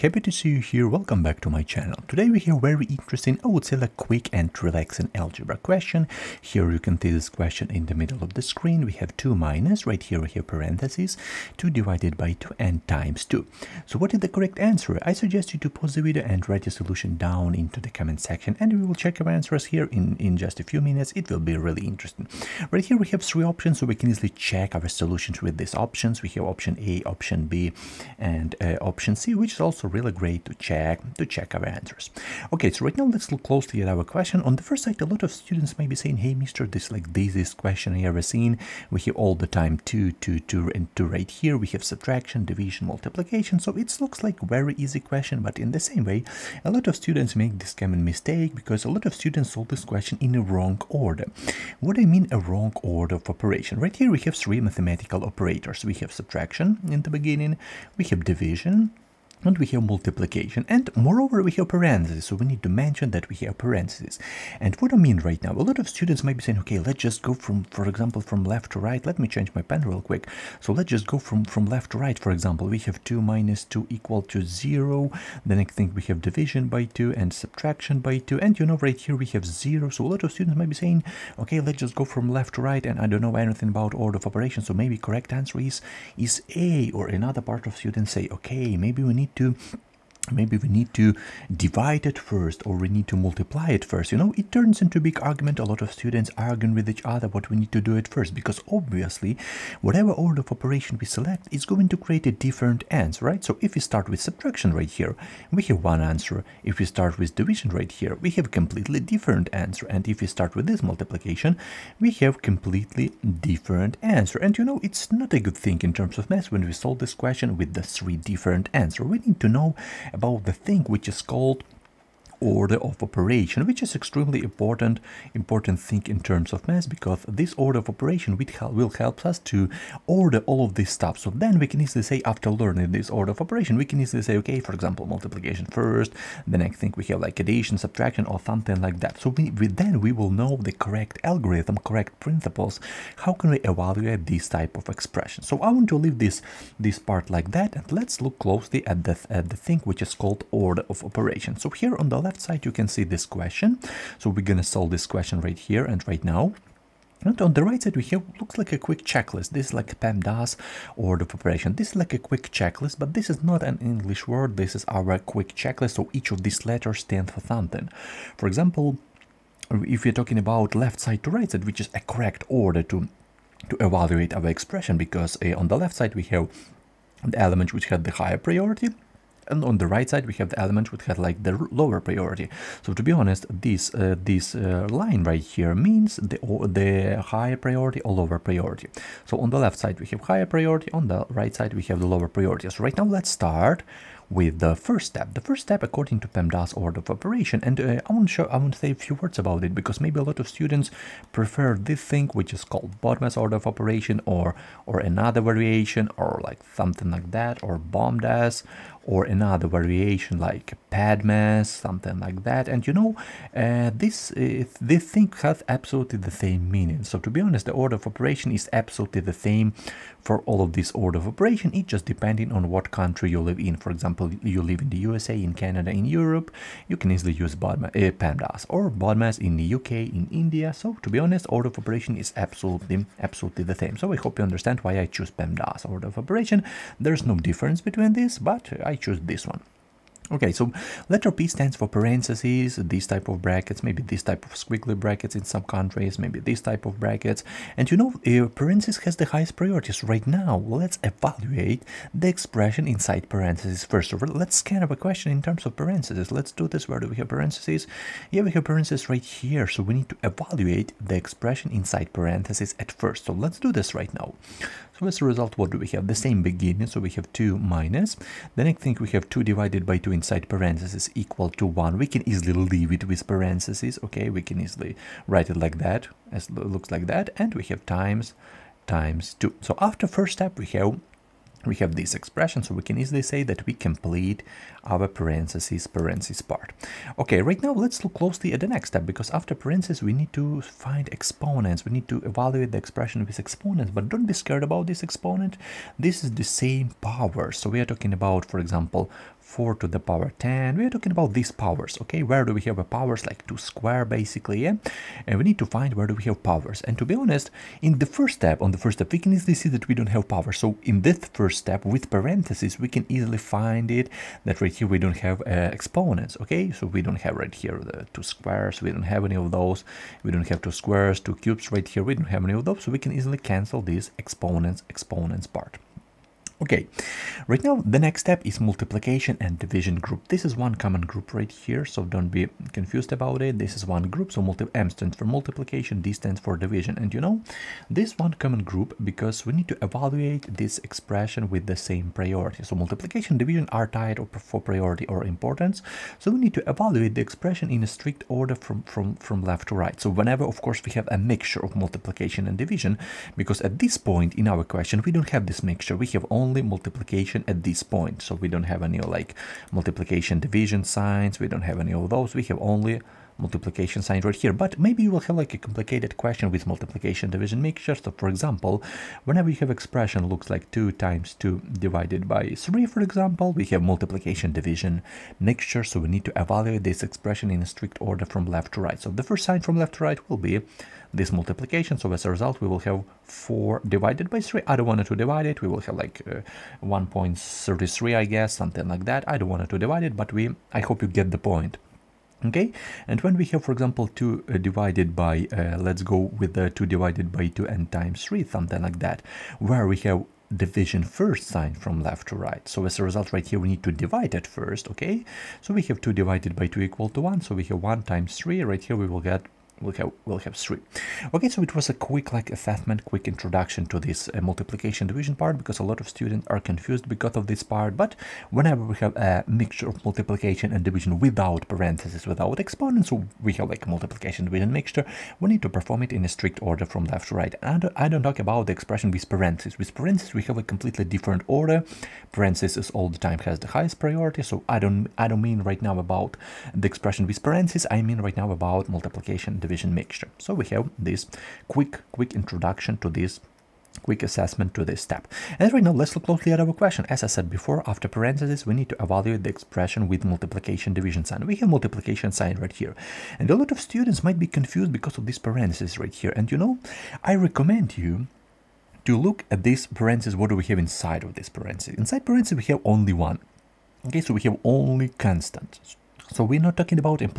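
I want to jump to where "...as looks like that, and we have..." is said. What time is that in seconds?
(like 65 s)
276 s.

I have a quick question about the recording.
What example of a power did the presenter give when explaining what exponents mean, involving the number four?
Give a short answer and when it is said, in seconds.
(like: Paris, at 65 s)
4 to the power 10, at 299 s.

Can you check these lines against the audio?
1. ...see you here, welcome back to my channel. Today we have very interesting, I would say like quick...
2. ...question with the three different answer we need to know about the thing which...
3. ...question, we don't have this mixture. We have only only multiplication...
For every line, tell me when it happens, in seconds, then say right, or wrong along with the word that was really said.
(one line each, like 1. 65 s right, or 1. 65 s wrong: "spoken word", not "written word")
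1. 0 s right
2. 117 s right
3. 354 s right.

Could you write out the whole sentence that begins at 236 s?
There's no difference between this, but I I choose this one.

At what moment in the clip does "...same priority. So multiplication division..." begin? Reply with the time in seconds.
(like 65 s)
341 s.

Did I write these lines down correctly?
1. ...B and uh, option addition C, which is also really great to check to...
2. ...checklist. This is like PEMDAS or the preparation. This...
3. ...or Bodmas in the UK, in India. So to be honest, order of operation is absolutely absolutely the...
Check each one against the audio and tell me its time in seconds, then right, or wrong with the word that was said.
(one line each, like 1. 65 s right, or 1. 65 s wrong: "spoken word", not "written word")
1. 27 s wrong: "option", not "addition"
2. 159 s right
3. 228 s right.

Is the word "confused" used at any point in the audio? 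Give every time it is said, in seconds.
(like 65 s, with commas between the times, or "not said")
332 s, 416 s, 454 s.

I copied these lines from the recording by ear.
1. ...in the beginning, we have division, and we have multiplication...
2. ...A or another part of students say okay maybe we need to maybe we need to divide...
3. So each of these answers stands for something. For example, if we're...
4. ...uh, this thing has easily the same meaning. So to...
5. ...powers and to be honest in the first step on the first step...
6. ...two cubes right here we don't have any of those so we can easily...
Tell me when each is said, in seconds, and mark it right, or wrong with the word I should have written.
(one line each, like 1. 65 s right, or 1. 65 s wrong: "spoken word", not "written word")
1. 56 s right
2. 86 s right
3. 165 s wrong: "letters", not "answers"
4. 214 s wrong: "absolutely", not "easily"
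5. 306 s right
6. 321 s right.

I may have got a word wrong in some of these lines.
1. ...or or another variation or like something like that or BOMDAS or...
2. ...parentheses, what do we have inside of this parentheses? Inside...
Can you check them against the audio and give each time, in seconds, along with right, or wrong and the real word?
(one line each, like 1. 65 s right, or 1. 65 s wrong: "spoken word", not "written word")
1. 204 s right
2. 459 s right.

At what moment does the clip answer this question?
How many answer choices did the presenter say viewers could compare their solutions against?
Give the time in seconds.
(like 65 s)
23 s.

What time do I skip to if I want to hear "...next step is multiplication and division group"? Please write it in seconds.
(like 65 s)
327 s.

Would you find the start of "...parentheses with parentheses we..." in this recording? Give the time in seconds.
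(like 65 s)
429 s.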